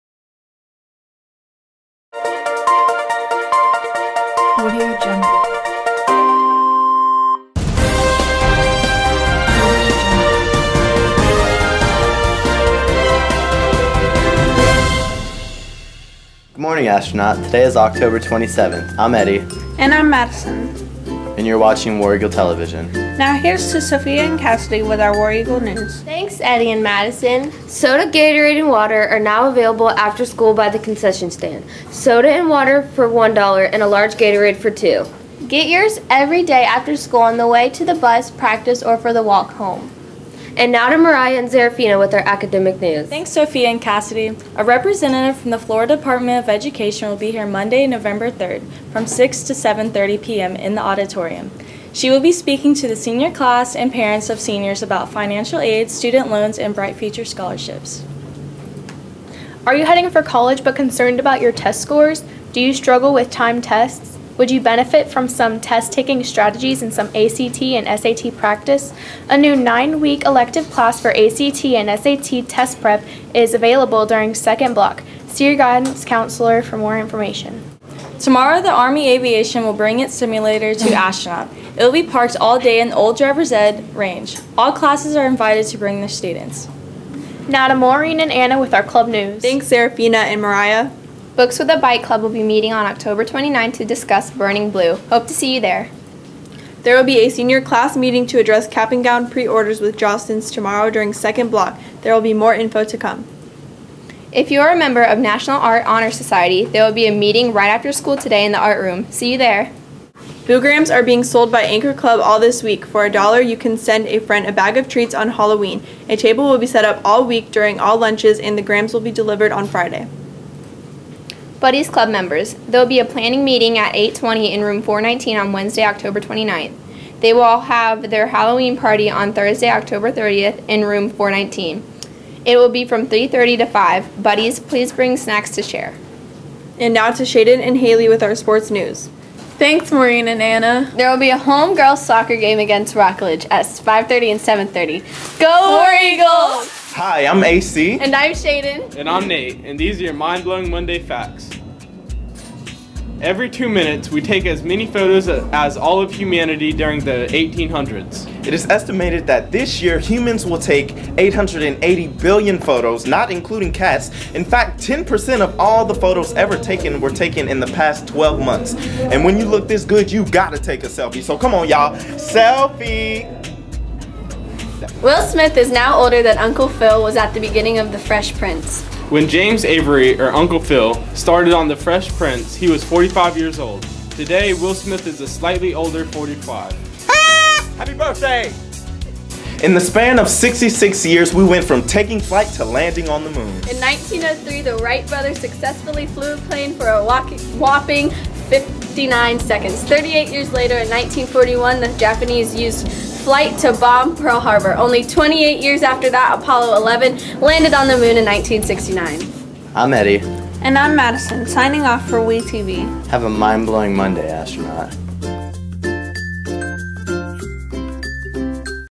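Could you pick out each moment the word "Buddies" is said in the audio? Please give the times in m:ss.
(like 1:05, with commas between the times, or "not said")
2:01, 2:14.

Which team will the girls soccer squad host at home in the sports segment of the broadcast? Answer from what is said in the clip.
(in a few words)
Rockledge.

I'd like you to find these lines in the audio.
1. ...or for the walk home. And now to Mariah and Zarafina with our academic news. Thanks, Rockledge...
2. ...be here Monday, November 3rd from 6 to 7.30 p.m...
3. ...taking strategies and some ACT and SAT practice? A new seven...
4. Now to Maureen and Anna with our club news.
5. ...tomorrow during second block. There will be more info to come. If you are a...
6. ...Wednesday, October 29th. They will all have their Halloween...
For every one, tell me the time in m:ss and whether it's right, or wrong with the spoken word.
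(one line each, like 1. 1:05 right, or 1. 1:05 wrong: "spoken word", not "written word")
1. 0:38 wrong: "Sophia", not "Rockledge"
2. 0:47 right
3. 1:05 wrong: "nine", not "seven"
4. 1:27 right
5. 1:40 right
6. 2:05 right.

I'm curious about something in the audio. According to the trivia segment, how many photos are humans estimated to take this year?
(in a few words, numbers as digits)
880 billion.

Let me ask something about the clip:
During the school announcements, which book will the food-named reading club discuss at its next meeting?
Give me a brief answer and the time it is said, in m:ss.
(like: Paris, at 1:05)
Burning Blue, at 1:34.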